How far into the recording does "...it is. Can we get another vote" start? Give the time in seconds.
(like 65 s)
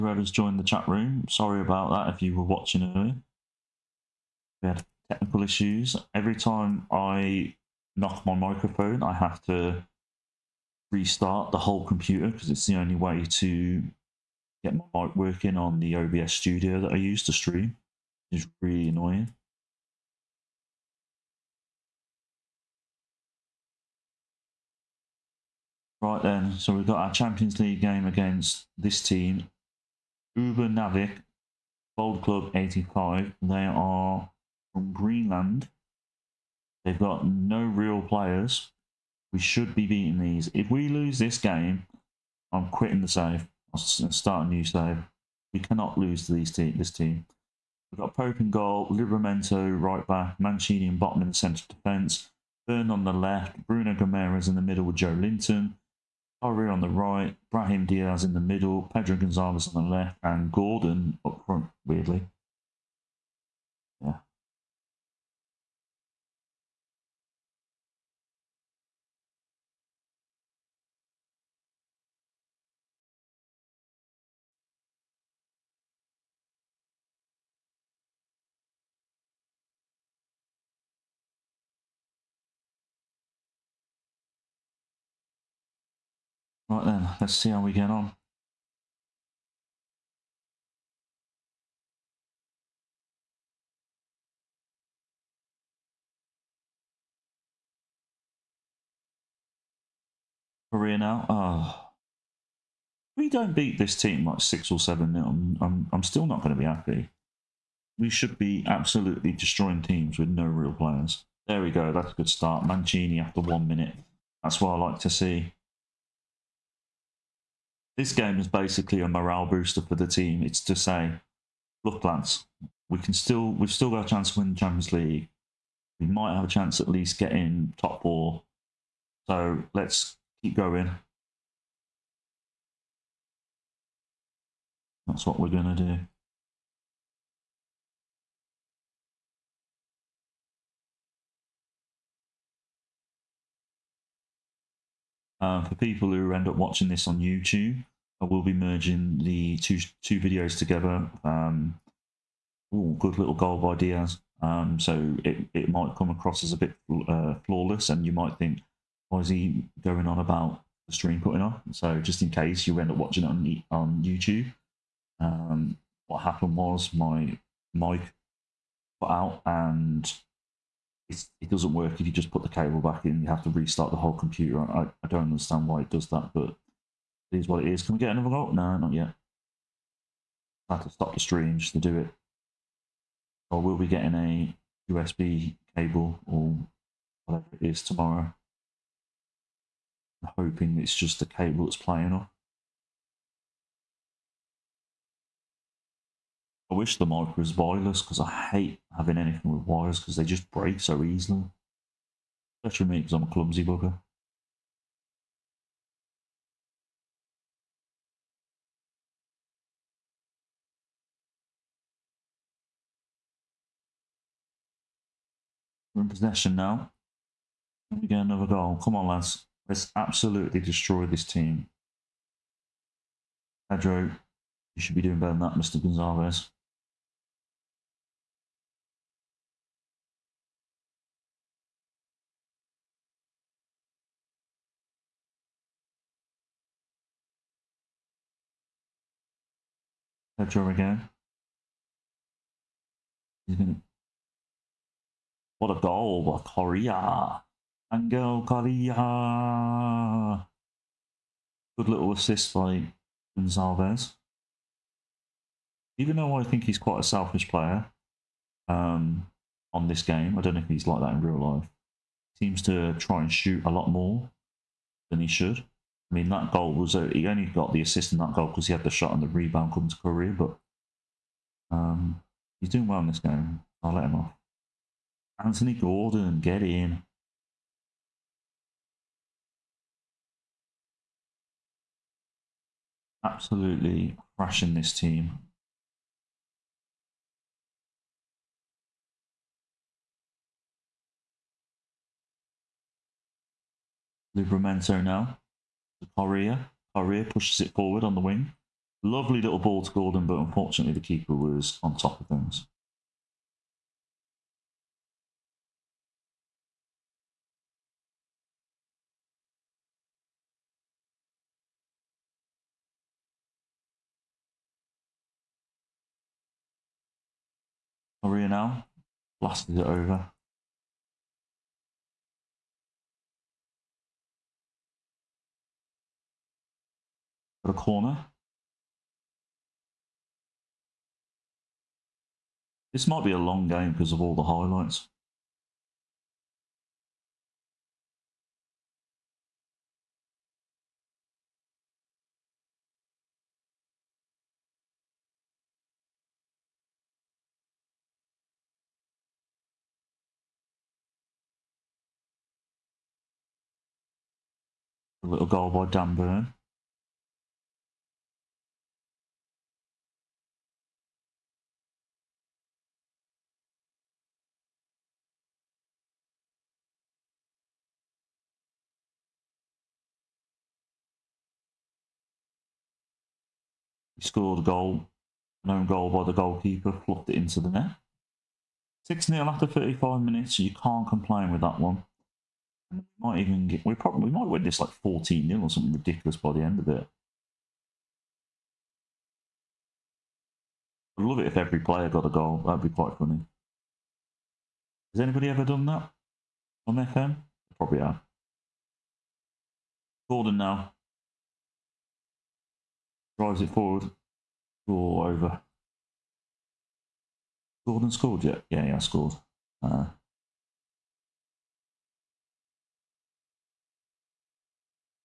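177 s.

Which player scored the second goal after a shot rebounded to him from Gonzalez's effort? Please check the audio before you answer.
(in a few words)
Angel Correa.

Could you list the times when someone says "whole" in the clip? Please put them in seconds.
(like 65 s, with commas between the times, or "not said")
11 s, 173 s.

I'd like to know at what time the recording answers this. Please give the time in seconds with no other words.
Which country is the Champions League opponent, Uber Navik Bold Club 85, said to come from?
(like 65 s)
34 s.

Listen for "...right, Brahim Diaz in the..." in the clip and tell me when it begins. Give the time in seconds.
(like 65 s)
56 s.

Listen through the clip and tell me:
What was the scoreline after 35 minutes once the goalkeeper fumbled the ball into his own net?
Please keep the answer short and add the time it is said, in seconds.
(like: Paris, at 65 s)
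6-0, at 379 s.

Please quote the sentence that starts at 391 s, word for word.
I'd love it if every player got a goal.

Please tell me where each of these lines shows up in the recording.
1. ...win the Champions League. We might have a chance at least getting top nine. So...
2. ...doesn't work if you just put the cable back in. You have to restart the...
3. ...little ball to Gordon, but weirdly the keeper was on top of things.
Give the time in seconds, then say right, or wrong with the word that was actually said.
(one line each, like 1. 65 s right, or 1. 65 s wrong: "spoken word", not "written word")
1. 124 s wrong: "four", not "nine"
2. 171 s right
3. 299 s wrong: "unfortunately", not "weirdly".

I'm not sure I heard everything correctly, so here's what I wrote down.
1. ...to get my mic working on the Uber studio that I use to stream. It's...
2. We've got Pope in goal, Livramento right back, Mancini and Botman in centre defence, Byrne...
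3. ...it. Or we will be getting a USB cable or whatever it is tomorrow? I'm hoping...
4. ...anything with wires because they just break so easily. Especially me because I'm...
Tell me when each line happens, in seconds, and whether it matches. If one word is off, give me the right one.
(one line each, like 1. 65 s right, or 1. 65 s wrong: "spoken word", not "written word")
1. 13 s wrong: "OBS", not "Uber"
2. 47 s right
3. 181 s right
4. 199 s right.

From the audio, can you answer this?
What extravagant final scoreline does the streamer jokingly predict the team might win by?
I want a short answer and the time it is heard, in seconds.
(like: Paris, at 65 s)
14-0, at 384 s.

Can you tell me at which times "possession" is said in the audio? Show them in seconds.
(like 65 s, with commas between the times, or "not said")
216 s.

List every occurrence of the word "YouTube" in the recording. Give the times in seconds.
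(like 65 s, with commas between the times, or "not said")
147 s, 164 s.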